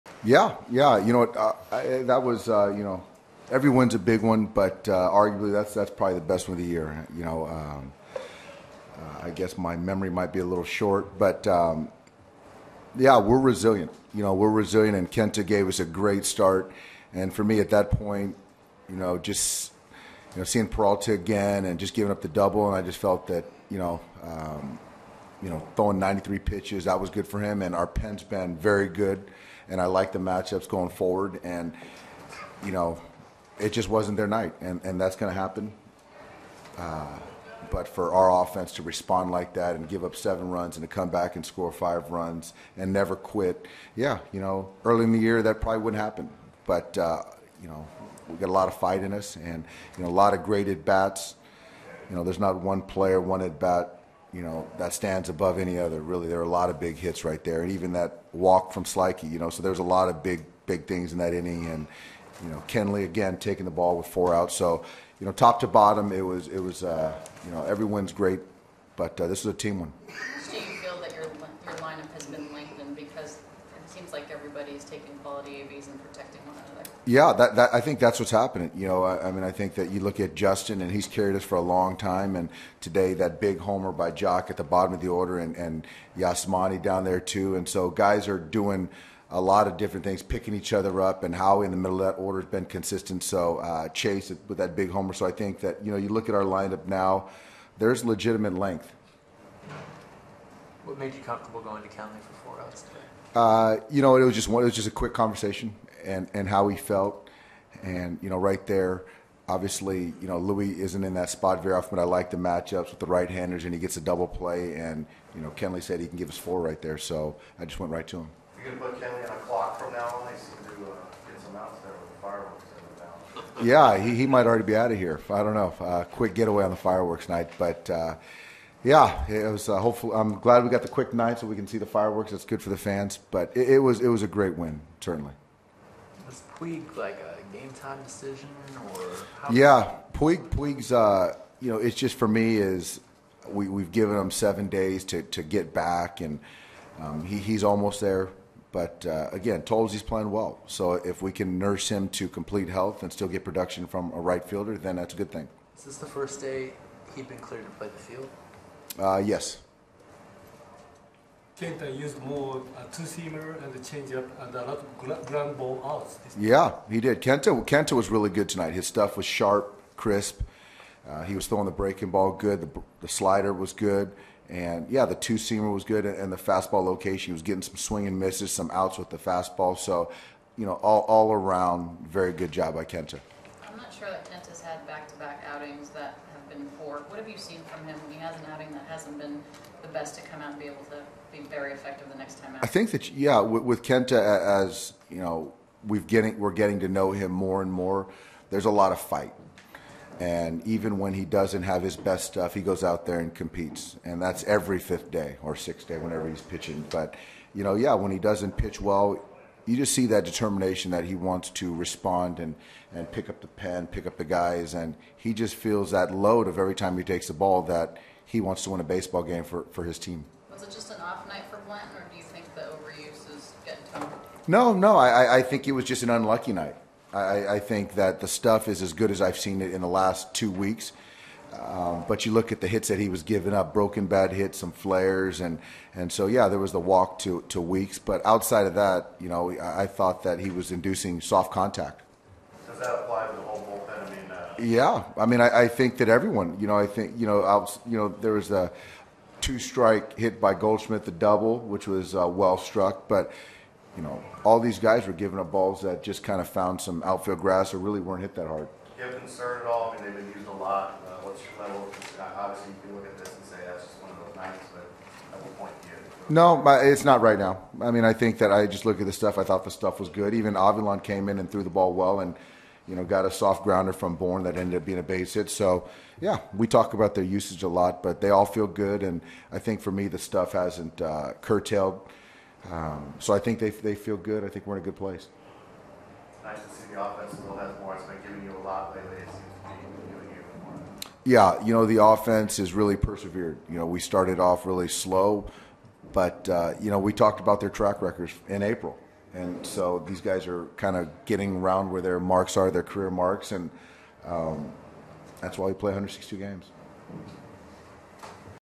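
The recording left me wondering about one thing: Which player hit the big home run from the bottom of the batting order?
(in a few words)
Joc.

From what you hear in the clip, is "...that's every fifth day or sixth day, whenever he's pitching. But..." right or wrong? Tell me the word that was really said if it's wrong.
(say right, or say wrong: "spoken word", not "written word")
right.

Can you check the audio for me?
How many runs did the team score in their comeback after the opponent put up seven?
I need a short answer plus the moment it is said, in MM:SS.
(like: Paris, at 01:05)
5, at 00:41.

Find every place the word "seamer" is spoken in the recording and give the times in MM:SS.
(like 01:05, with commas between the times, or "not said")
02:42, 02:55.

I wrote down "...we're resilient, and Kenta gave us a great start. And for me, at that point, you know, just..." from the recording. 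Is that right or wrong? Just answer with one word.
right.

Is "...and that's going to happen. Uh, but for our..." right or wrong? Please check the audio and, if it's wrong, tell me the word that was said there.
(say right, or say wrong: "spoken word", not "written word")
right.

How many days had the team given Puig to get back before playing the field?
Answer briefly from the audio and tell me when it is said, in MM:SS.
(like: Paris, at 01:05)
7, at 02:24.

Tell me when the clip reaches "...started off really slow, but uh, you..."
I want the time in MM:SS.
04:53.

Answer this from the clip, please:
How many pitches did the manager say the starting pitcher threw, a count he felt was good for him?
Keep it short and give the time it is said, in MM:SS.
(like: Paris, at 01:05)
93, at 00:25.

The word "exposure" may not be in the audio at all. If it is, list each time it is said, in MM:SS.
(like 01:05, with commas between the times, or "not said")
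not said.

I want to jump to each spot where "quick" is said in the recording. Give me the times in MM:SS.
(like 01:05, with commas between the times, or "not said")
01:44, 02:06, 02:10.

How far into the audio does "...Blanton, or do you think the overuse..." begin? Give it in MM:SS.
03:41.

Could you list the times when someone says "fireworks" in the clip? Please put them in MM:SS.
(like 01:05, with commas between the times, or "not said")
02:06, 02:11.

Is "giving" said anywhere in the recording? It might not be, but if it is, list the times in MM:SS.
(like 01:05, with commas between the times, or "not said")
00:21, 03:53, 04:15, 04:48.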